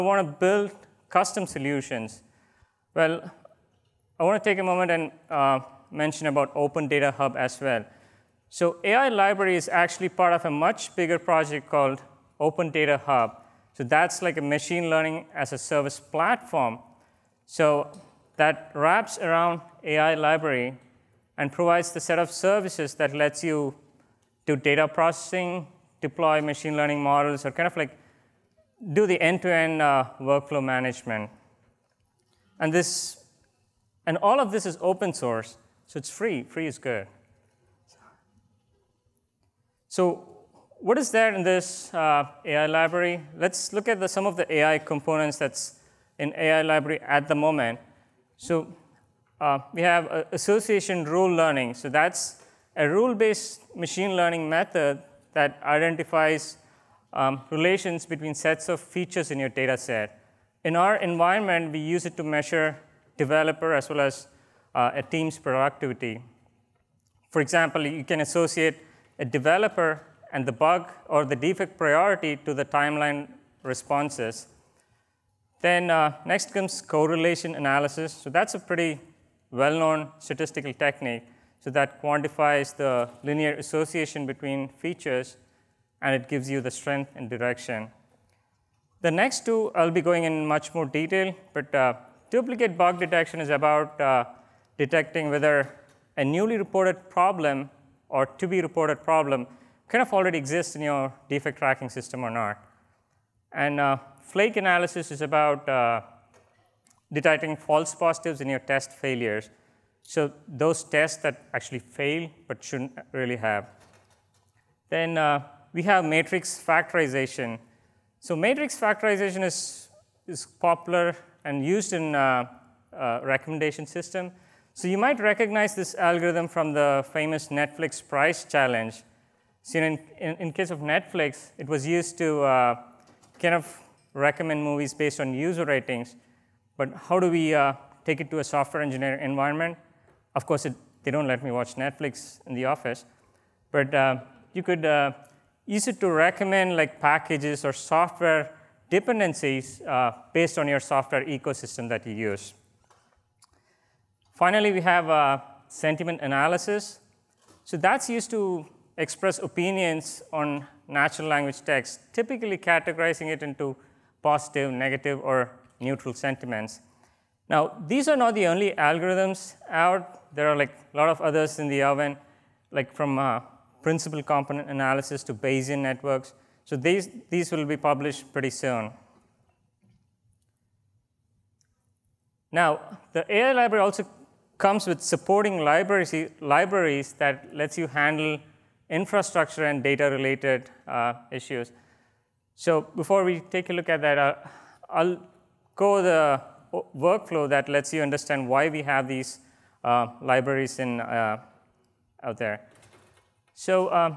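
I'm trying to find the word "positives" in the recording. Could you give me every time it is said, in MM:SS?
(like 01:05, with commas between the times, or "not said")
01:47, 02:44.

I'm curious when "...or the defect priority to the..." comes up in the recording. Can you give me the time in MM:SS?
01:11.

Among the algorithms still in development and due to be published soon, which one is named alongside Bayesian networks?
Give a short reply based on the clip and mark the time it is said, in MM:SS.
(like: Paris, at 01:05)
principal component analysis, at 02:53.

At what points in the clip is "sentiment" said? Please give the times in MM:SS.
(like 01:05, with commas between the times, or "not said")
02:35, 02:46.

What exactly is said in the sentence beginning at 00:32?
And this, and all of this is open source.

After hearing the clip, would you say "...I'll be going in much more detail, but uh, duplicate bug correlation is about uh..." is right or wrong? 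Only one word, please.
wrong.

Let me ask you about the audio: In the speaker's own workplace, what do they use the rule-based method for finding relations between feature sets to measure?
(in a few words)
productivity.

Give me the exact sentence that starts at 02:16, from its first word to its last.
But how do we uh, take it to a software engineer environment?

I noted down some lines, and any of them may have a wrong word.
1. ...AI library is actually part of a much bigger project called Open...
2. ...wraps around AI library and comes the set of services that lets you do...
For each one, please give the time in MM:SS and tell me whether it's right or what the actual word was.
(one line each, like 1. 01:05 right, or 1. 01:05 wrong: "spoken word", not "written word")
1. 00:08 right
2. 00:18 wrong: "provides", not "comes".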